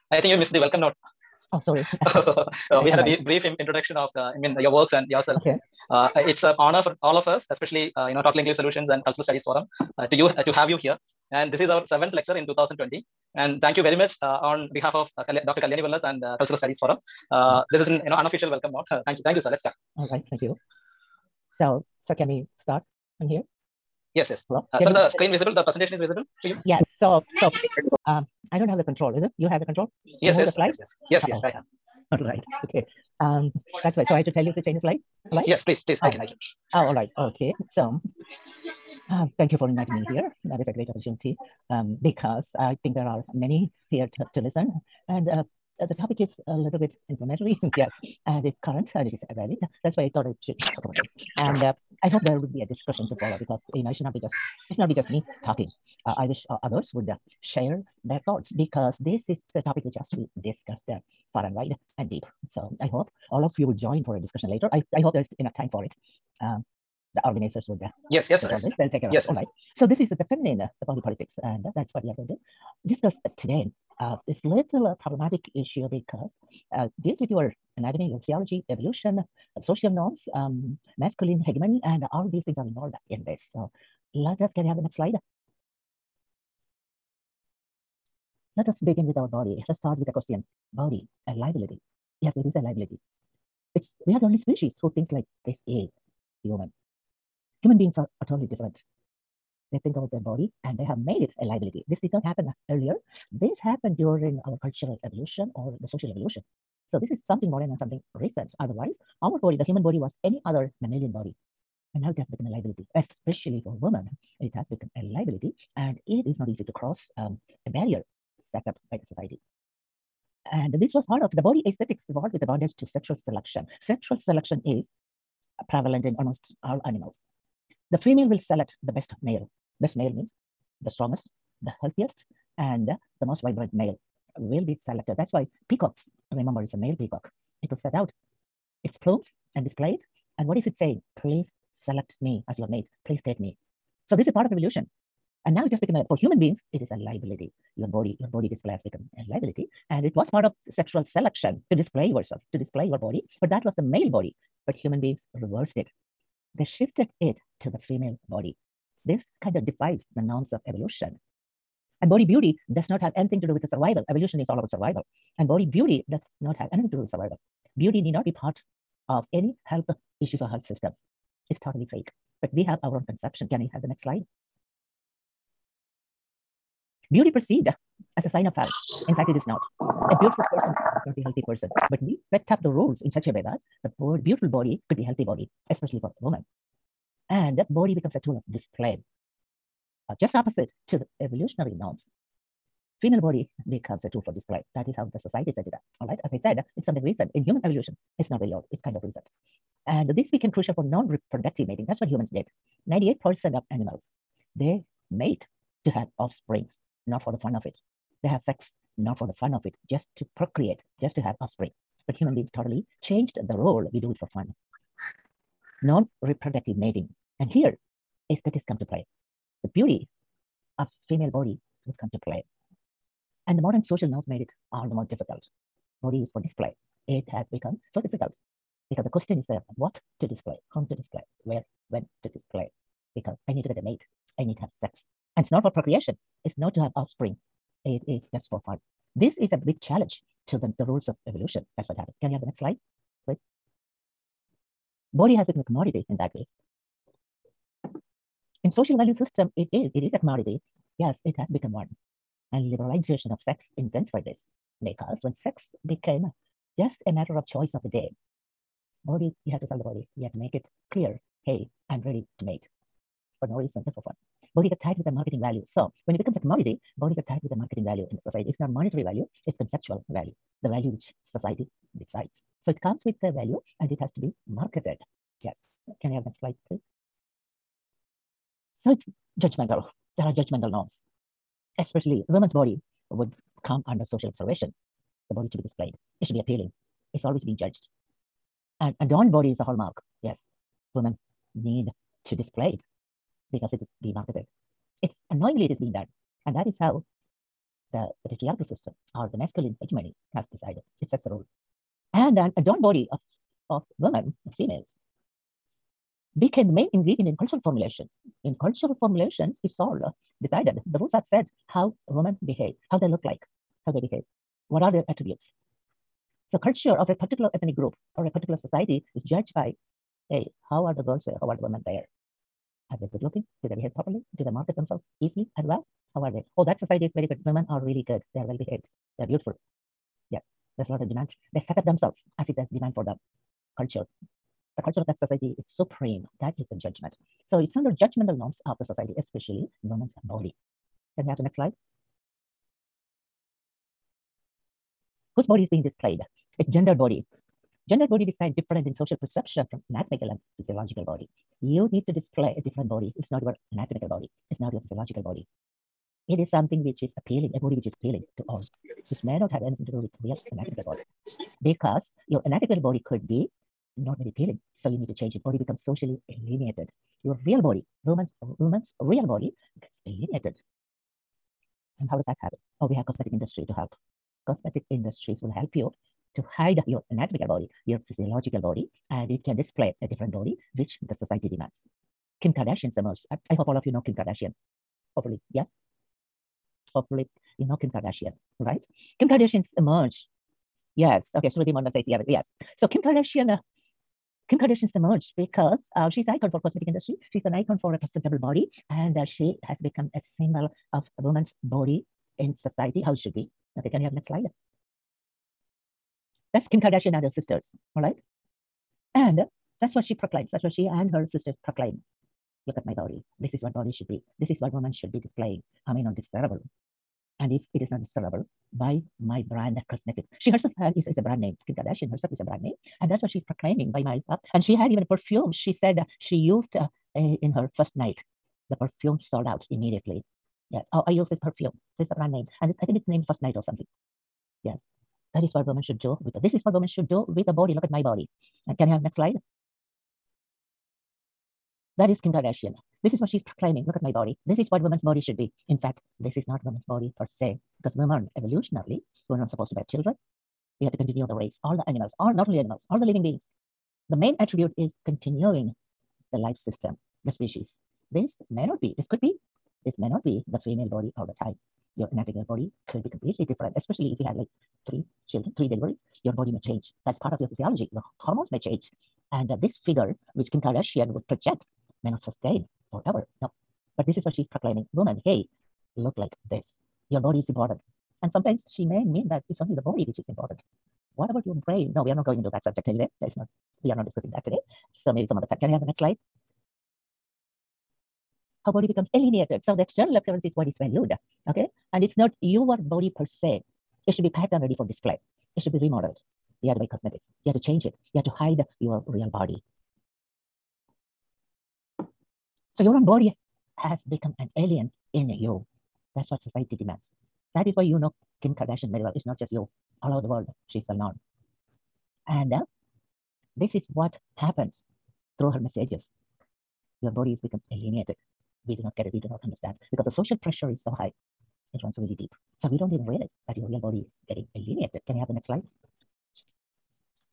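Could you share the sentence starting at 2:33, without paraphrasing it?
But that was the male body but human beings reversed it.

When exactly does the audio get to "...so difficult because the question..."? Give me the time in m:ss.
3:47.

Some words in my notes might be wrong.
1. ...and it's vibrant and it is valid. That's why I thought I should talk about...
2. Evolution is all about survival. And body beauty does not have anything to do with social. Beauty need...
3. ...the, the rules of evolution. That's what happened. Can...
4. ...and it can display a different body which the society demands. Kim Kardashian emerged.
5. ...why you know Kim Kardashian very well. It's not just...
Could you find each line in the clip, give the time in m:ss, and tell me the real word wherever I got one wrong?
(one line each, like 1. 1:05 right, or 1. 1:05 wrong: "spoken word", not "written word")
1. 0:48 wrong: "current", not "vibrant"
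2. 2:44 wrong: "survival", not "social"
3. 4:00 right
4. 6:19 right
5. 8:27 right.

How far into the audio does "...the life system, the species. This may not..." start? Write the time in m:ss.
7:36.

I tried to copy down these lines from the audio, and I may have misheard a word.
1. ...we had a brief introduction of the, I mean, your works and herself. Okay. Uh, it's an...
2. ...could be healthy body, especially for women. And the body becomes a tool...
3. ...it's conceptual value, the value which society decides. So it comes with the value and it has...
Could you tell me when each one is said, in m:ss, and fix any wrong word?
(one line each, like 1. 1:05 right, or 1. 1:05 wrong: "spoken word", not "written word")
1. 0:02 wrong: "yourself", not "herself"
2. 3:04 right
3. 4:29 right.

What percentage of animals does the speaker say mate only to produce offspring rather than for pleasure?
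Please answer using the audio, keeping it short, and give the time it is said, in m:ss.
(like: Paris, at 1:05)
98%, at 3:22.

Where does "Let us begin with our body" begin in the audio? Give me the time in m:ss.
1:28.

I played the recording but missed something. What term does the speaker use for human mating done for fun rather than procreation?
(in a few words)
non-reproductive mating.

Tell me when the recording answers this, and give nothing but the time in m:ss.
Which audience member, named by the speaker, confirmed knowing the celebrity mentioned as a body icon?
6:31.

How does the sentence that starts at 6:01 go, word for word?
Because your anatomical body could be not very appealing.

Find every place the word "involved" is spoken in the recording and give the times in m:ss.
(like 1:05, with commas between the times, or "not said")
1:22, 2:02.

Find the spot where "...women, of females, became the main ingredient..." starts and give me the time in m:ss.
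5:03.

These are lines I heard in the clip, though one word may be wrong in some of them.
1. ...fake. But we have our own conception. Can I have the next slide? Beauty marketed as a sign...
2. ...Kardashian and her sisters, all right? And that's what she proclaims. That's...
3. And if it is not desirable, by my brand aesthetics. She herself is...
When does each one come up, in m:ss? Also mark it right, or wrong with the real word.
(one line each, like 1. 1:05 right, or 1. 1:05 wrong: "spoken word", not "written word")
1. 2:51 wrong: "perceived", not "marketed"
2. 6:46 right
3. 6:57 wrong: "cosmetics", not "aesthetics".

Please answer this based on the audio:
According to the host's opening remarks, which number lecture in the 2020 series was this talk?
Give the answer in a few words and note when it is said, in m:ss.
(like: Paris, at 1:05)
seventh, at 0:11.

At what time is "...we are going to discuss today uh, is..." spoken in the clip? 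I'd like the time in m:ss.
1:12.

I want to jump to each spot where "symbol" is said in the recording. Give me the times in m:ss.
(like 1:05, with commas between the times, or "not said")
6:40.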